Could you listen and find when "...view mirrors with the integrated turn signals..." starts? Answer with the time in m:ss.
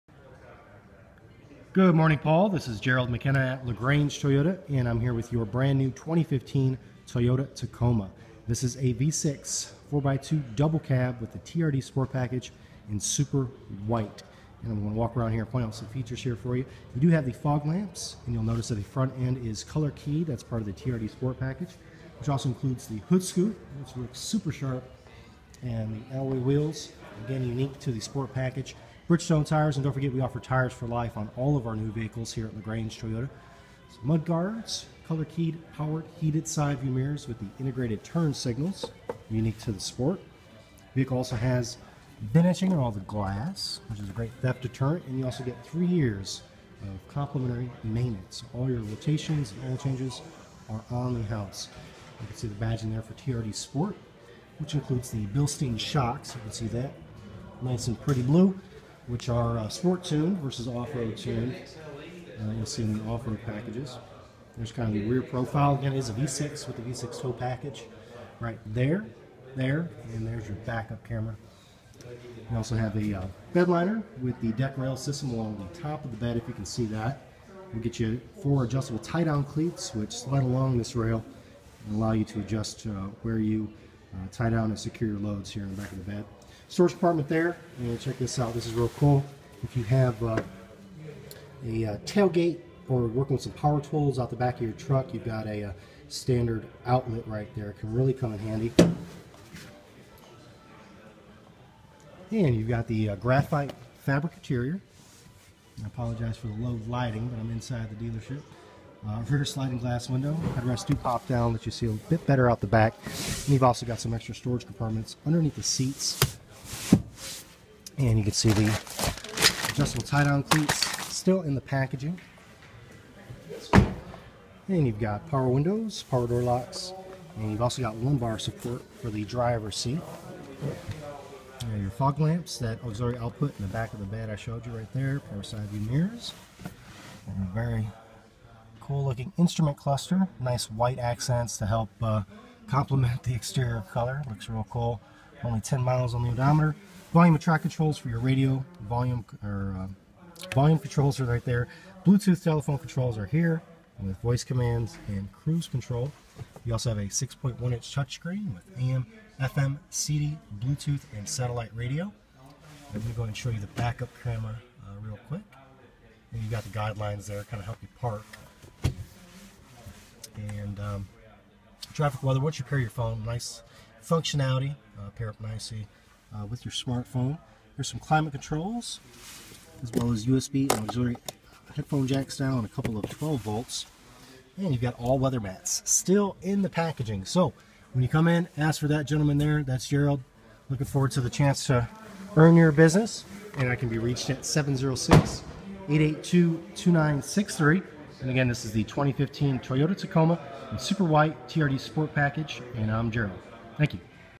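0:36.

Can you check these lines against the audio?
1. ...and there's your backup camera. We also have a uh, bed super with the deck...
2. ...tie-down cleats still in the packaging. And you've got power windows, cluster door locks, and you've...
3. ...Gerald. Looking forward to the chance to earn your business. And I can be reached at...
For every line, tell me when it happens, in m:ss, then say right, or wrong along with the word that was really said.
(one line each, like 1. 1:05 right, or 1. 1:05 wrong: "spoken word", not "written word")
1. 1:10 wrong: "liner", not "super"
2. 2:00 wrong: "power", not "cluster"
3. 3:09 right.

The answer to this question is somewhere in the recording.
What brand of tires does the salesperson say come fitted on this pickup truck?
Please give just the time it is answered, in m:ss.
0:29.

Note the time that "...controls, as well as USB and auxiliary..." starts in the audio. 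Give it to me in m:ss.
2:58.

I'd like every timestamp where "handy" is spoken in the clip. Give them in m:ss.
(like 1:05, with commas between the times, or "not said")
1:38.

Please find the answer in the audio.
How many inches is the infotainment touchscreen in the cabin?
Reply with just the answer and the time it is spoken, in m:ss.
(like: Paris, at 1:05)
6.1 inch, at 2:37.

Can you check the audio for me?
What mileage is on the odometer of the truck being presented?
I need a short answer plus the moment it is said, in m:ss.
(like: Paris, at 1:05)
10, at 2:25.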